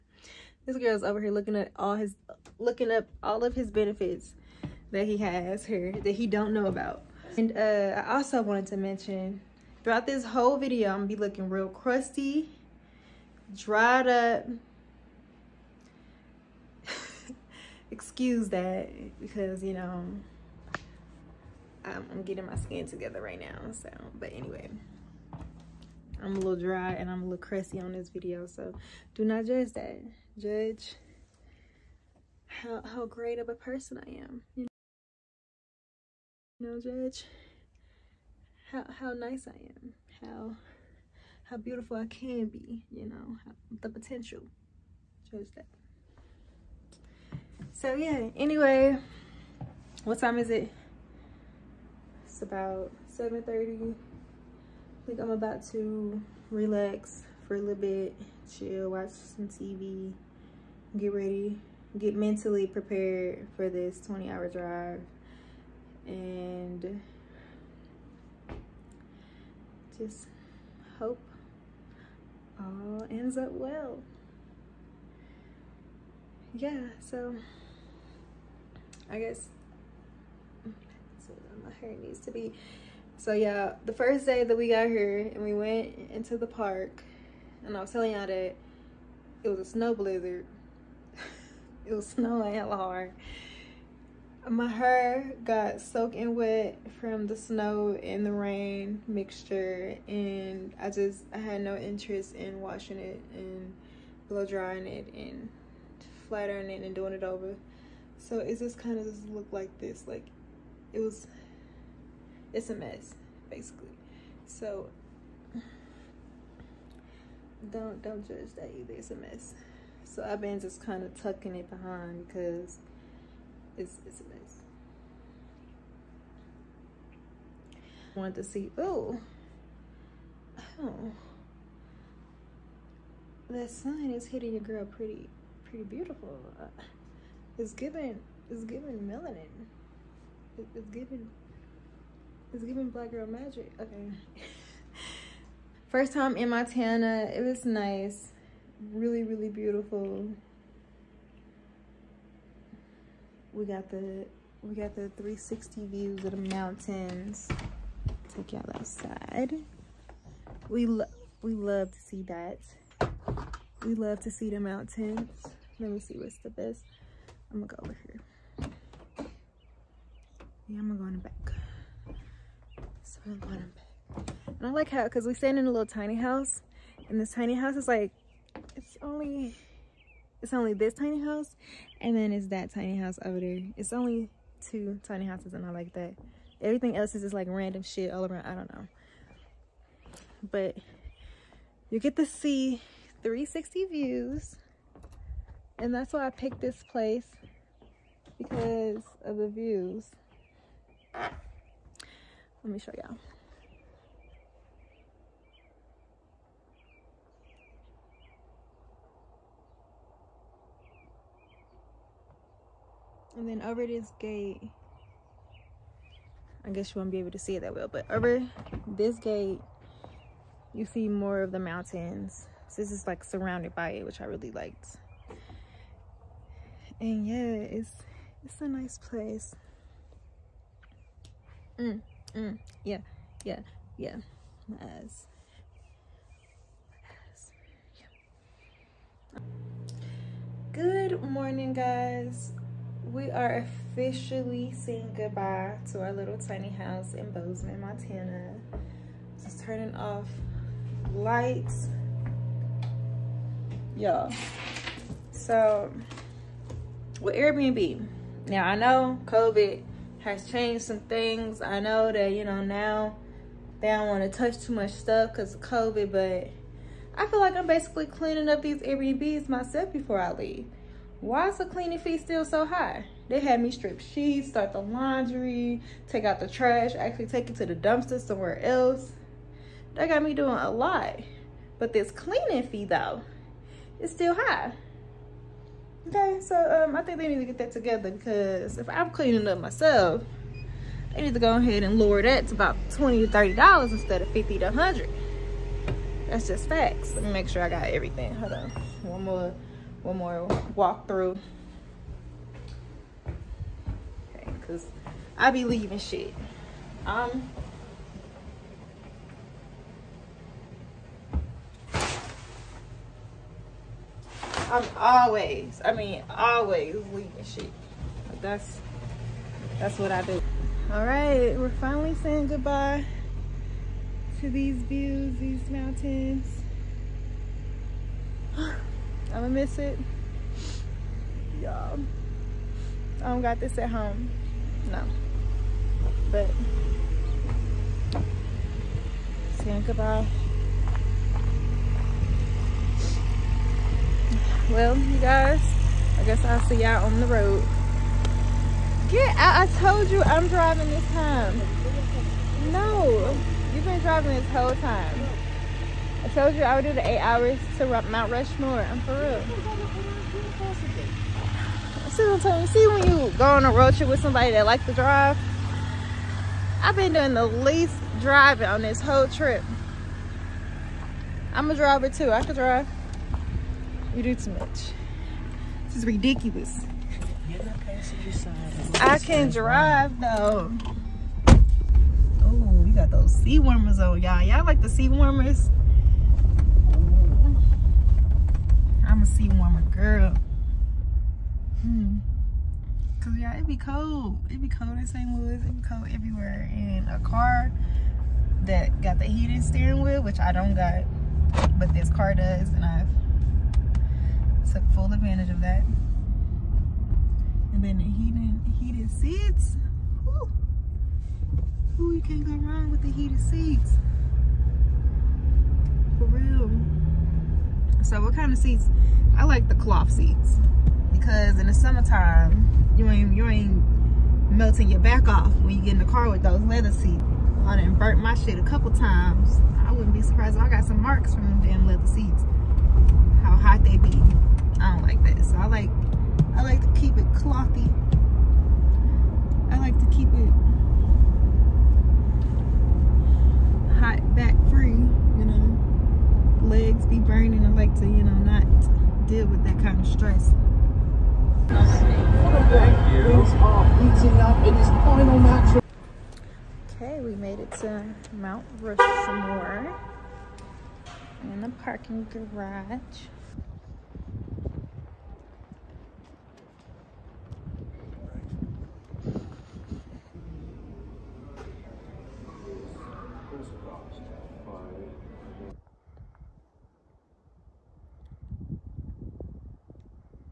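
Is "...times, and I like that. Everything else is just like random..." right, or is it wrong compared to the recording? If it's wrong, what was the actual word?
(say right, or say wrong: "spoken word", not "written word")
wrong: "houses", not "times".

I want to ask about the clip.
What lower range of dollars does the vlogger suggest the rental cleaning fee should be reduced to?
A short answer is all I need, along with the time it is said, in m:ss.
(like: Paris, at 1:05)
$20 to $30, at 4:52.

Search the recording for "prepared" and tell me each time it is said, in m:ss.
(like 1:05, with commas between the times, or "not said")
1:02.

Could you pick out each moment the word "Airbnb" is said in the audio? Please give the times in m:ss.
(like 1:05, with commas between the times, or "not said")
4:17, 4:28.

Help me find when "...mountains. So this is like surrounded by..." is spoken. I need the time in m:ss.
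3:41.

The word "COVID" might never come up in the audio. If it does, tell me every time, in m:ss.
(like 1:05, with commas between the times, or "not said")
4:19, 4:25.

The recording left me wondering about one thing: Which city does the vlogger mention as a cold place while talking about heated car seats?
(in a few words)
St. Louis.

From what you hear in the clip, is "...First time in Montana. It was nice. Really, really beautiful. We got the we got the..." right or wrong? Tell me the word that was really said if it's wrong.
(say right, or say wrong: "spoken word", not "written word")
right.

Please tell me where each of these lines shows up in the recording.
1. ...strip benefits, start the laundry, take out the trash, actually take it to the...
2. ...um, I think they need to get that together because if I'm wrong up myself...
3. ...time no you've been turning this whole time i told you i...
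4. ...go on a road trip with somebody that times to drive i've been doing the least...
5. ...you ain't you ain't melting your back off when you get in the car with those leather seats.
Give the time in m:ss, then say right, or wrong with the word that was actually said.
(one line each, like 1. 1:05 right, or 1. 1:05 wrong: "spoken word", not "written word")
1. 4:33 wrong: "sheets", not "benefits"
2. 4:46 wrong: "cleaning", not "wrong"
3. 5:51 wrong: "driving", not "turning"
4. 6:03 wrong: "likes", not "times"
5. 7:02 right.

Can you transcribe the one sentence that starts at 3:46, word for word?
And yeah, it's it's a nice place.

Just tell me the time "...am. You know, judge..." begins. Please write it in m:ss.
0:34.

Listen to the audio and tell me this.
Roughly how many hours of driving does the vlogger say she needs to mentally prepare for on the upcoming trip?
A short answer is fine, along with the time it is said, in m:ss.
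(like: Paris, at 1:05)
20, at 1:04.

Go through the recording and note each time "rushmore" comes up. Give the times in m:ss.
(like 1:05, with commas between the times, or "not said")
5:58, 7:38.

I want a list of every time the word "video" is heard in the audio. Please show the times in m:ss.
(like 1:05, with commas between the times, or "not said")
0:10, 0:28.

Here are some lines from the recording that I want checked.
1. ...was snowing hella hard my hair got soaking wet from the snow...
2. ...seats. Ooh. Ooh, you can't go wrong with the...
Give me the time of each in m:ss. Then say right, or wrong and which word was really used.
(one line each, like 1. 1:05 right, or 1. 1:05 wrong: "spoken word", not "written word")
1. 1:31 right
2. 6:49 right.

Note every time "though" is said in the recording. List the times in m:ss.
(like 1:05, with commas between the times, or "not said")
4:42, 6:20.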